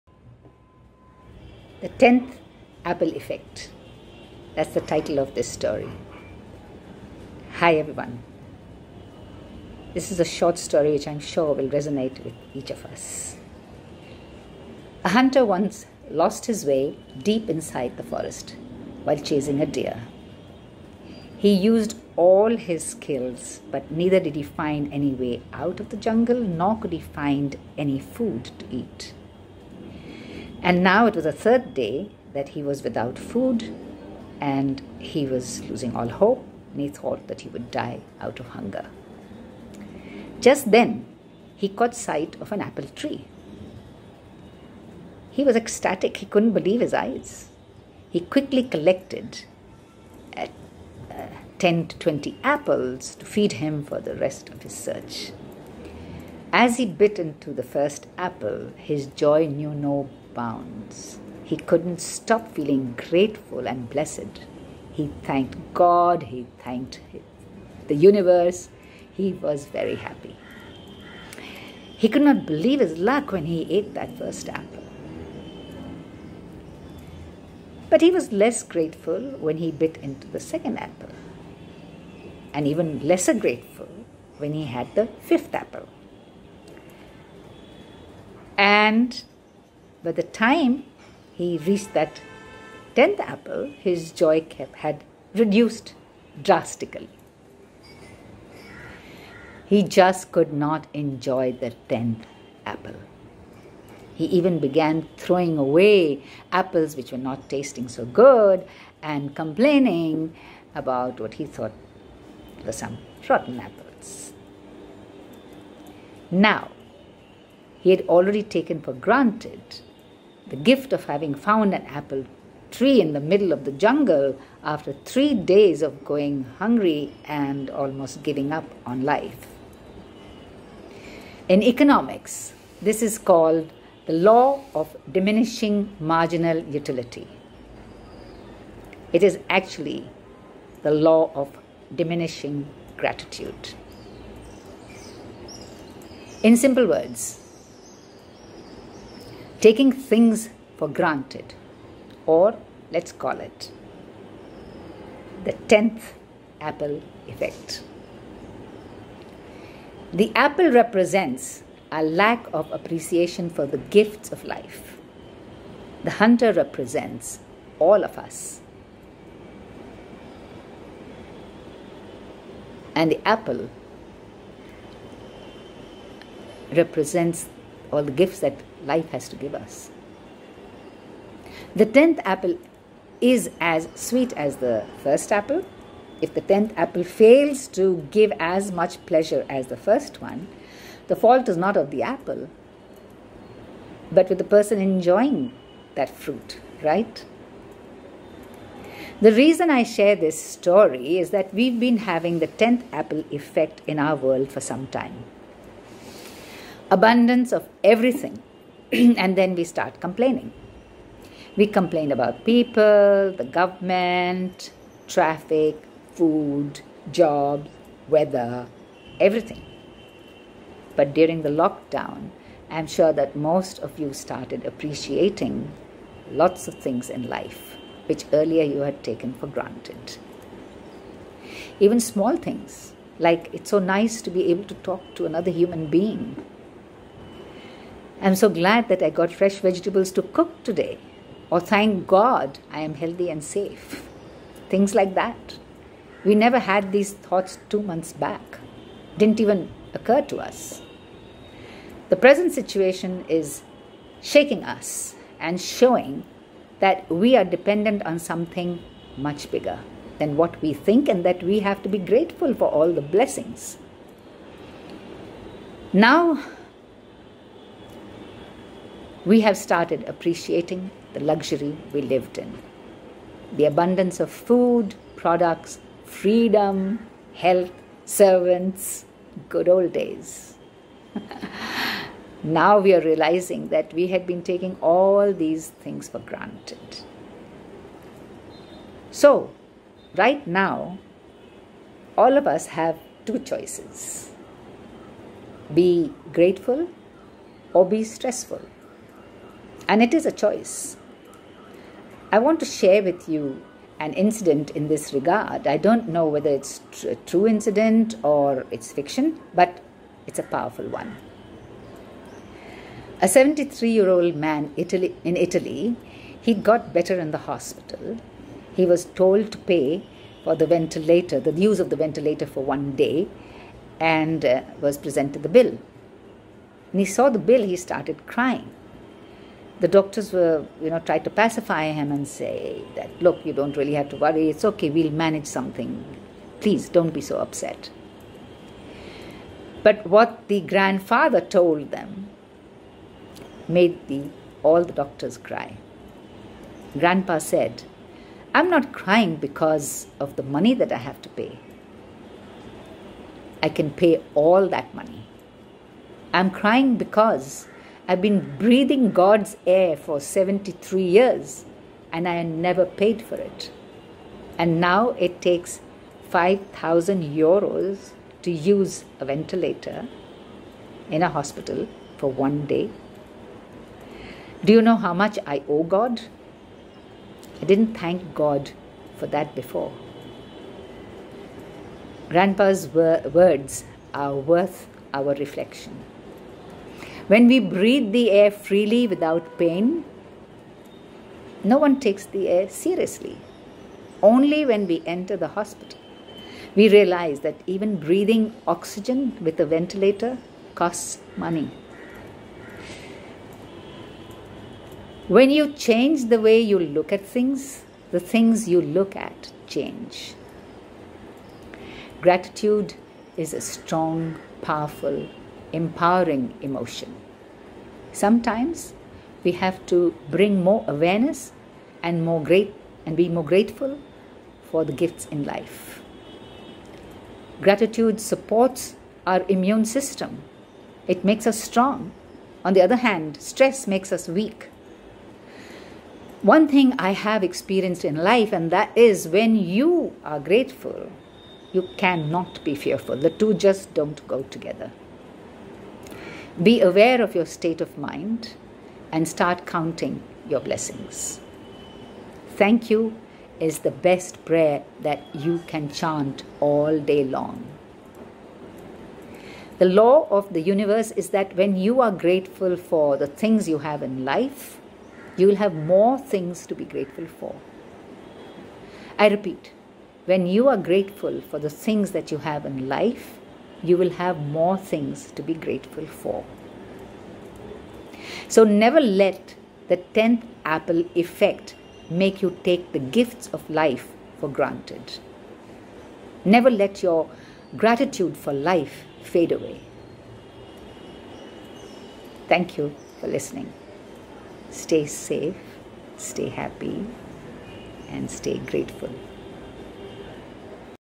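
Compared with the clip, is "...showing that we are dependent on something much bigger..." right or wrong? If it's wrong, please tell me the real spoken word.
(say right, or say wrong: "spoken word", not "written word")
right.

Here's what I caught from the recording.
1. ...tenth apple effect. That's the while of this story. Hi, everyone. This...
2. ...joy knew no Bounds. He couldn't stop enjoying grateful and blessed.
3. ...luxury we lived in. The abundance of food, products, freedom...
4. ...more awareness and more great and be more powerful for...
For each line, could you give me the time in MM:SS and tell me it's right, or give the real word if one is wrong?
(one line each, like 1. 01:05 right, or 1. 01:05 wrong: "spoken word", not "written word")
1. 00:02 wrong: "title", not "while"
2. 00:59 wrong: "feeling", not "enjoying"
3. 04:31 right
4. 07:00 wrong: "grateful", not "powerful".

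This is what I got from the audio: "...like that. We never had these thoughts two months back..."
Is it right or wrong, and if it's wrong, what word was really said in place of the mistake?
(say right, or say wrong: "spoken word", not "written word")
right.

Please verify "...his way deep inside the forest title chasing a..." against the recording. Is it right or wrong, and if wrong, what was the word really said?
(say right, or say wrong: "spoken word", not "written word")
wrong: "while", not "title".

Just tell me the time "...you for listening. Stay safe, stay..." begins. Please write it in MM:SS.
08:12.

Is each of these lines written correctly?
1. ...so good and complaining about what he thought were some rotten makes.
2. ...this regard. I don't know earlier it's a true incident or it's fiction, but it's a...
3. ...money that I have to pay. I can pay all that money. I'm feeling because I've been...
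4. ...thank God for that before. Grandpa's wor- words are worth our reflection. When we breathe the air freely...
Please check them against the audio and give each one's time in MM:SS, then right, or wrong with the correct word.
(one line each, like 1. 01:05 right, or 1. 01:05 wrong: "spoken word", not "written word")
1. 01:47 wrong: "apples", not "makes"
2. 05:04 wrong: "whether", not "earlier"
3. 05:50 wrong: "crying", not "feeling"
4. 06:17 right.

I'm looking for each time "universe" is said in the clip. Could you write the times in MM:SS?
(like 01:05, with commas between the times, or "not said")
01:07, 07:40.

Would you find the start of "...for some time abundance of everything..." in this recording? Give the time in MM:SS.
03:24.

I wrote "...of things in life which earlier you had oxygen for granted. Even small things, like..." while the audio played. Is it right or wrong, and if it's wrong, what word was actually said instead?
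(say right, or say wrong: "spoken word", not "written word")
wrong: "taken", not "oxygen".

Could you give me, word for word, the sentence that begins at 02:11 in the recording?
In economics, this is called the law of diminishing marginal utility.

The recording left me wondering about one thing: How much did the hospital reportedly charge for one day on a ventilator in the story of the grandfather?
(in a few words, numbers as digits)
5,000 euros.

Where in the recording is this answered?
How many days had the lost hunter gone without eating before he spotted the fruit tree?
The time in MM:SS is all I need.
00:31.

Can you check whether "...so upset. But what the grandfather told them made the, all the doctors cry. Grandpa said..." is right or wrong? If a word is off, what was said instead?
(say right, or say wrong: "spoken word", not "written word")
right.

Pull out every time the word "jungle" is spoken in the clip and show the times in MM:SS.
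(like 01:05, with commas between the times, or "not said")
00:25, 02:03.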